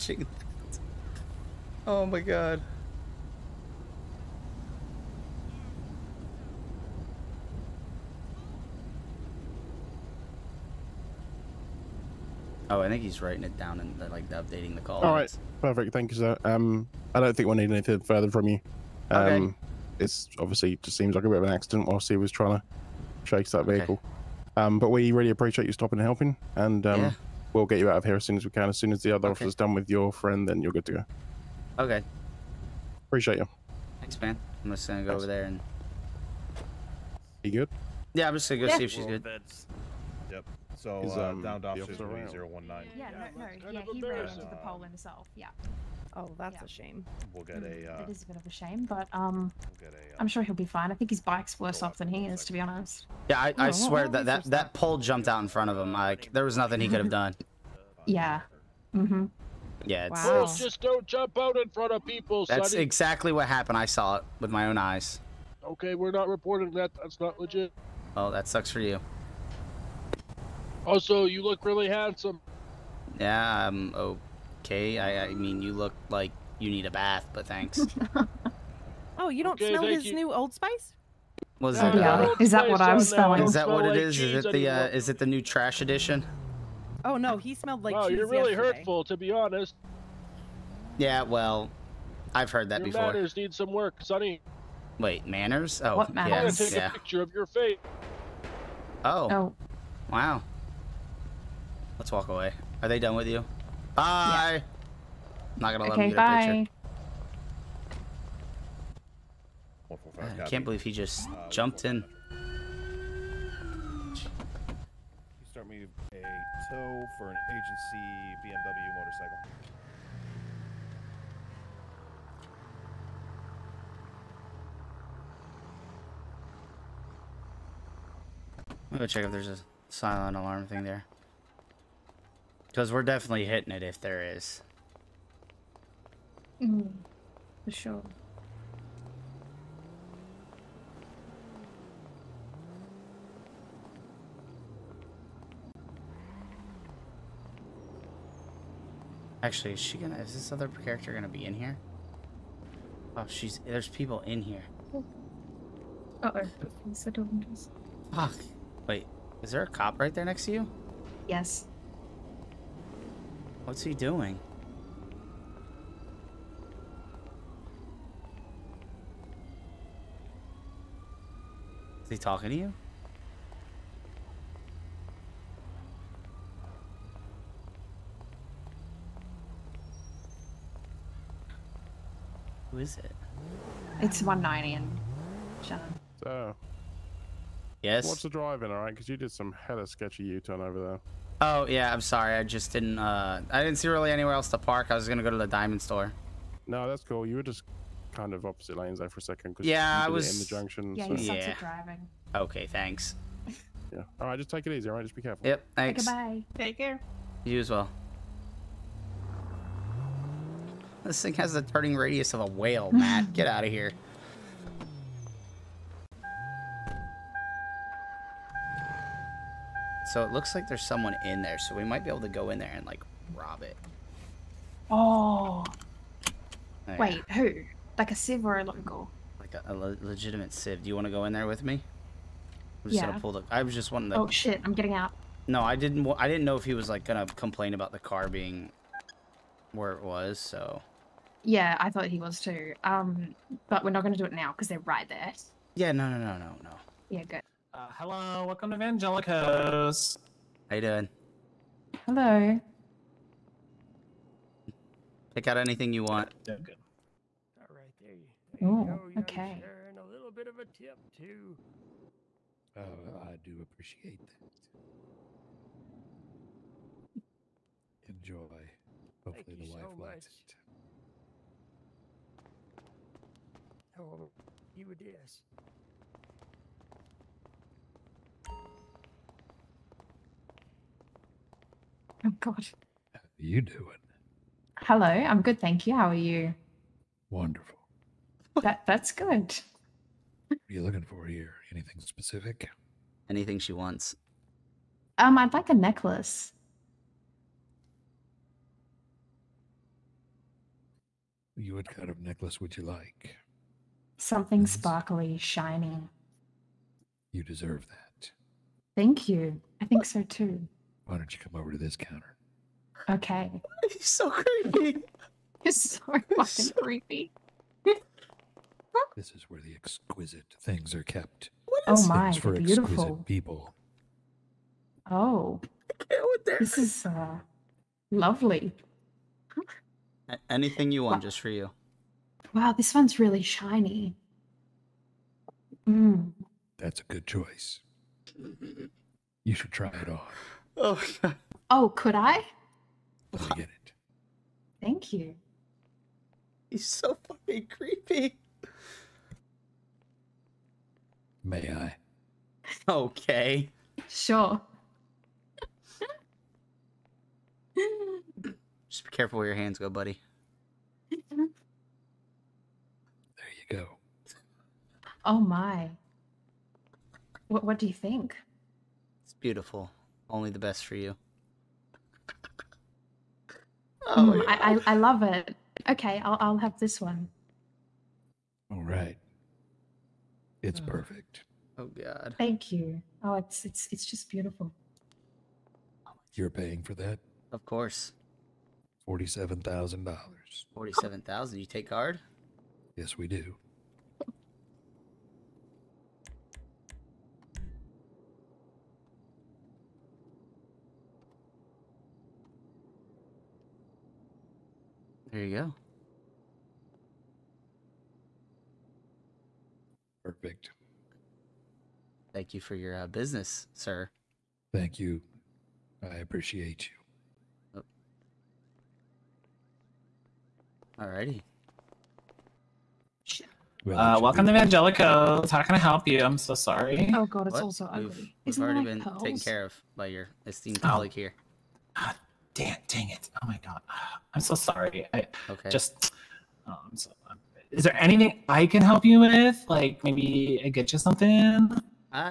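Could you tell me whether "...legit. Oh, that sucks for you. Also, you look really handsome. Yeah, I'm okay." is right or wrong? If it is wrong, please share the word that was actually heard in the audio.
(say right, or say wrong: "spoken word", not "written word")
right.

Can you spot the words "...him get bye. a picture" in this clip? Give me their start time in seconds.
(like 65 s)
106 s.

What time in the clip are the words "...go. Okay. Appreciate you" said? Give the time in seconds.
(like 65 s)
30 s.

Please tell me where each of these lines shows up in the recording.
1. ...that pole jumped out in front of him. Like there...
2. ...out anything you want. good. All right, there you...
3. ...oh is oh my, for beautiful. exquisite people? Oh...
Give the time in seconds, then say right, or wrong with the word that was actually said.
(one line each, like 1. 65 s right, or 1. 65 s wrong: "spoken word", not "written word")
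1. 54 s right
2. 255 s right
3. 321 s right.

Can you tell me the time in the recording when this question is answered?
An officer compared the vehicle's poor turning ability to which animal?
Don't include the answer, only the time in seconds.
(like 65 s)
212 s.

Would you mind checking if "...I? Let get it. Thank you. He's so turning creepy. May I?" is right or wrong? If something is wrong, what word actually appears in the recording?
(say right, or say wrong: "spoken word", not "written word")
wrong: "fucking", not "turning".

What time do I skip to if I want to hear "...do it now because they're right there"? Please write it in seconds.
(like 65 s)
244 s.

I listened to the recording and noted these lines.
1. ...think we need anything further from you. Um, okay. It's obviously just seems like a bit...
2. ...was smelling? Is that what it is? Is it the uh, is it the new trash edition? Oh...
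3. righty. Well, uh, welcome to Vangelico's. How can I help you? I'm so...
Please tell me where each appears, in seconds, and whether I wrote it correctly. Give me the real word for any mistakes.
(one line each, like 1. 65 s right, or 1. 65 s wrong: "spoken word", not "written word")
1. 17 s right
2. 82 s right
3. 421 s right.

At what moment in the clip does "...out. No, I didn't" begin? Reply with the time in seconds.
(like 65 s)
234 s.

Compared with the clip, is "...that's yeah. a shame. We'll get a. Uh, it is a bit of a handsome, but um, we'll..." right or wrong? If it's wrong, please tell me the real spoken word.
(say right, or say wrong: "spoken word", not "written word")
wrong: "shame", not "handsome".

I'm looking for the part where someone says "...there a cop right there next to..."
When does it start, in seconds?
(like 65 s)
159 s.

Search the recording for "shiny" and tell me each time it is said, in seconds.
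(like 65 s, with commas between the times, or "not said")
305 s, 333 s.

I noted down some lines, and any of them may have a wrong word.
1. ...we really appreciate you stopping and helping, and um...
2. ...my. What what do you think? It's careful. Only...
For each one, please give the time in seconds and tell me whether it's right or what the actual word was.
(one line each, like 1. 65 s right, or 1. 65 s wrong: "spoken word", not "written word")
1. 24 s right
2. 365 s wrong: "beautiful", not "careful".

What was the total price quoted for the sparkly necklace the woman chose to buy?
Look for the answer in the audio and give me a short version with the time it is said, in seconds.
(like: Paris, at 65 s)
$47,000, at 389 s.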